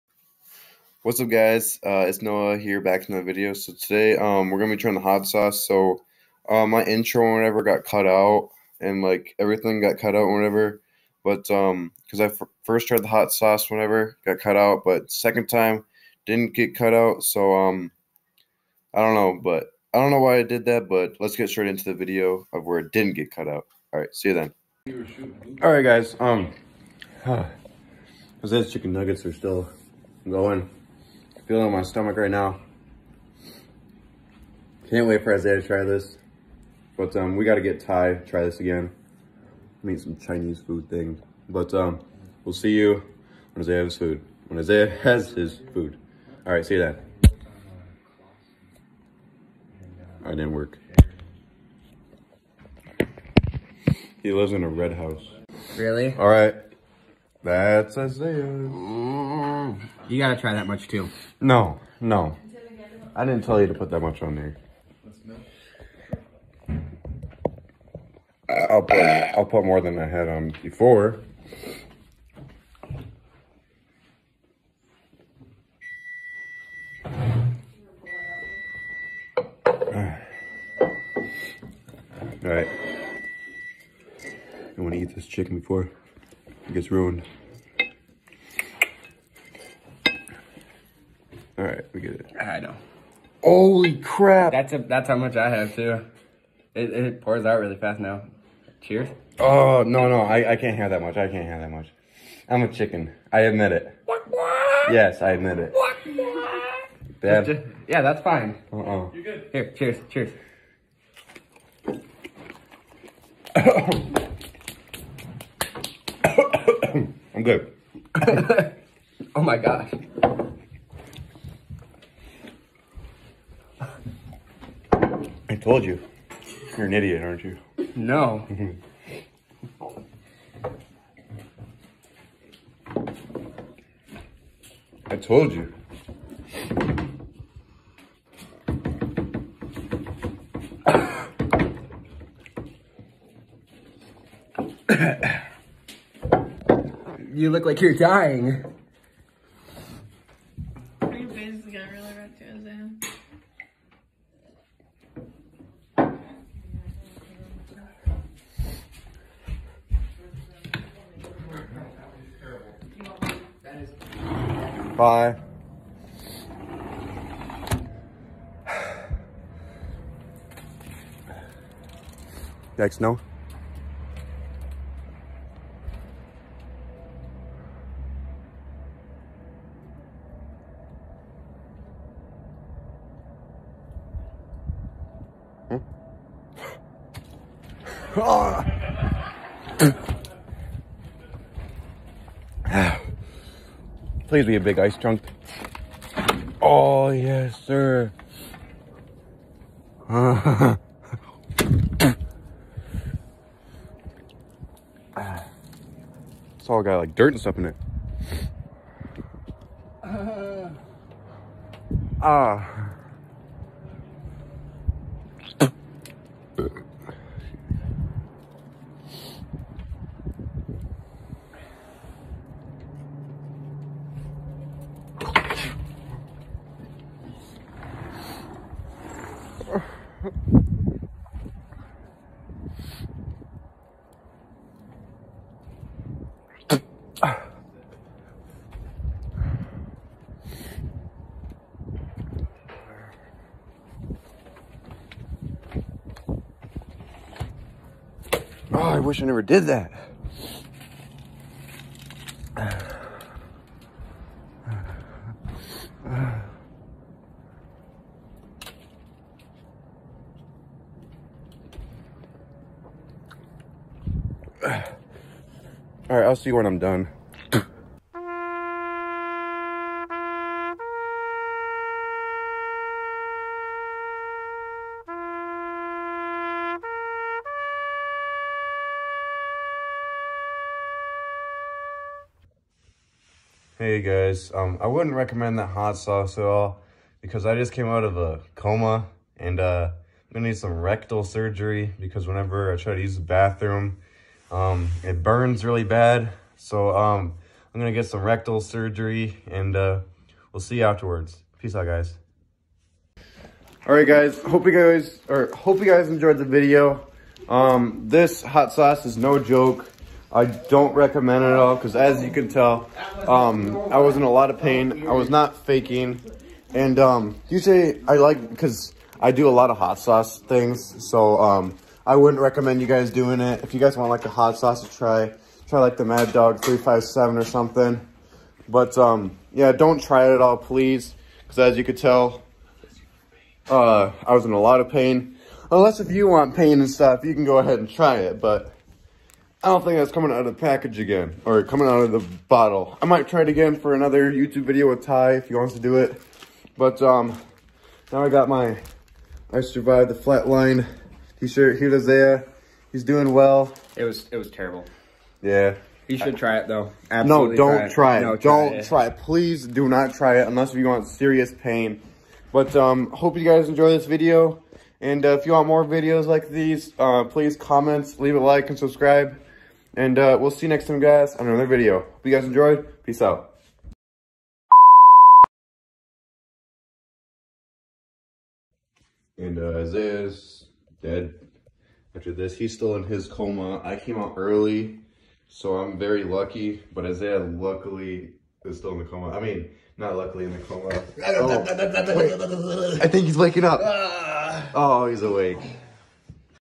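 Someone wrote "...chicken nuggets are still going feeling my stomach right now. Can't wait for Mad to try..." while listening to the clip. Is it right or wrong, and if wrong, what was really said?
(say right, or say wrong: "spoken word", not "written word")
wrong: "Isaiah", not "Mad".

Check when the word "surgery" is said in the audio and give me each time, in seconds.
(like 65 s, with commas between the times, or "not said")
291 s, 298 s.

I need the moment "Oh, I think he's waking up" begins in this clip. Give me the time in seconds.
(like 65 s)
391 s.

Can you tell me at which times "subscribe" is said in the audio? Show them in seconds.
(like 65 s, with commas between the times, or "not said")
368 s.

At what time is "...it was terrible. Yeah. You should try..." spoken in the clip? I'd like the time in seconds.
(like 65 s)
354 s.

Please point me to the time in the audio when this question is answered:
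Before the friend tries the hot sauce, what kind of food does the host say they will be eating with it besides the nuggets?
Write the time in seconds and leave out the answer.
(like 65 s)
40 s.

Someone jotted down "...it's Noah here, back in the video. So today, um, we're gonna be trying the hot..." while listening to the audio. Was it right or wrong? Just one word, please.
right.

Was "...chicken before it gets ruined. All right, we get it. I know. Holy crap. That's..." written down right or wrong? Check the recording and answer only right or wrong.
right.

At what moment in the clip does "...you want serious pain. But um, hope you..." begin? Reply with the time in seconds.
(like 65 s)
360 s.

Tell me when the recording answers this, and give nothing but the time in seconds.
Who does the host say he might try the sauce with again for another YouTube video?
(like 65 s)
345 s.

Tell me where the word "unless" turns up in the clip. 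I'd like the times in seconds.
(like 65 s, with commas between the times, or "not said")
335 s, 360 s.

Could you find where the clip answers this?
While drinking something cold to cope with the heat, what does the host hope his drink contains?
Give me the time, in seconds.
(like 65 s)
194 s.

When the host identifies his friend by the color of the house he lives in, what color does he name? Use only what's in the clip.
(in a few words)
Red.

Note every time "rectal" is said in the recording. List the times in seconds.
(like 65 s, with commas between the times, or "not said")
290 s, 298 s.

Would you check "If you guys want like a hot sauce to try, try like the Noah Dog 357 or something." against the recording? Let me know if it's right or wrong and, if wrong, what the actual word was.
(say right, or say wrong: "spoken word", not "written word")
wrong: "Mad", not "Noah".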